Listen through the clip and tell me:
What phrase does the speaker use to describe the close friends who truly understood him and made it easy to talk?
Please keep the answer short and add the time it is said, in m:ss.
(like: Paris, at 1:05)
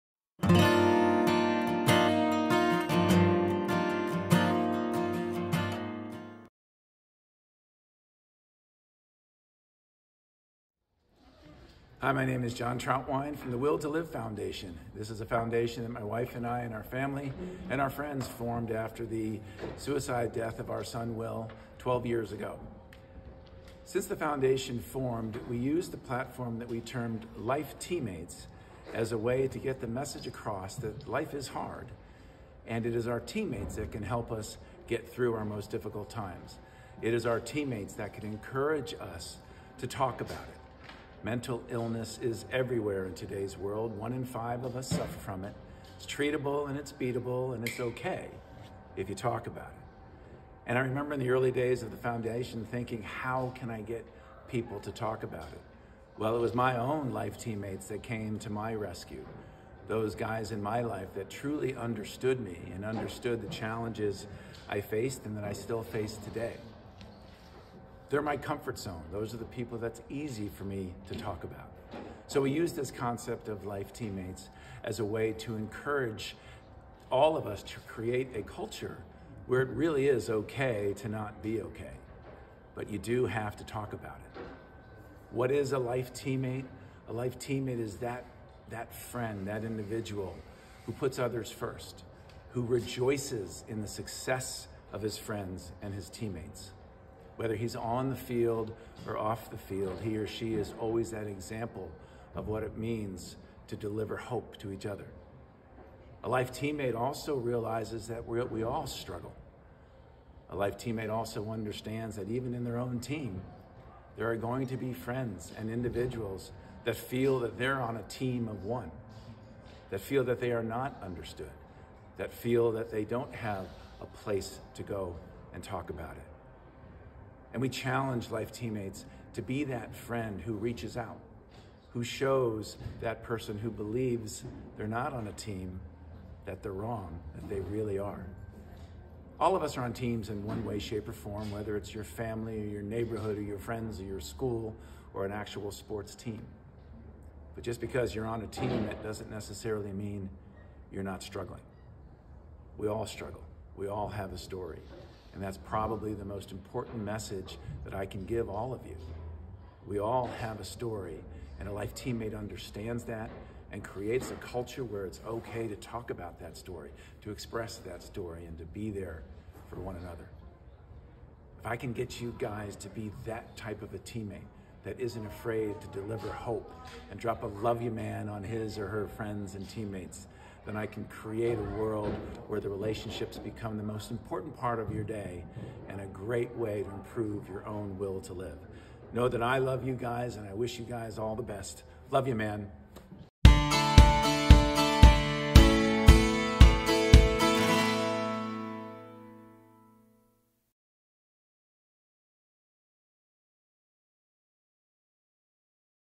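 comfort zone, at 1:08.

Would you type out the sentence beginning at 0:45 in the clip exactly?
It's treatable and it's beatable and it's okay if you talk about it.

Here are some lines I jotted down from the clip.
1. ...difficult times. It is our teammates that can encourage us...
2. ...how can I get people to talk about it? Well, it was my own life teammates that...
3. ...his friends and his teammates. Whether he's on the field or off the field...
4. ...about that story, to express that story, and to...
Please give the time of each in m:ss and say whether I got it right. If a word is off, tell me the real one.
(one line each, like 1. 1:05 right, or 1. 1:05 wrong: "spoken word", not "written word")
1. 0:35 right
2. 0:53 right
3. 1:35 right
4. 2:46 right.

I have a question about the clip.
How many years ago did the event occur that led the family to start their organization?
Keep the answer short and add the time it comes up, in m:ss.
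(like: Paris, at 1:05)
12, at 0:21.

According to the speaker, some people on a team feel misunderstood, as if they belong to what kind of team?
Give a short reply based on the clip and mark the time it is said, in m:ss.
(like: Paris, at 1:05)
a team of one, at 1:58.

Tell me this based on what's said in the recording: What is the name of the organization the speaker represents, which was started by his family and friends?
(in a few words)
Will to Live Foundation.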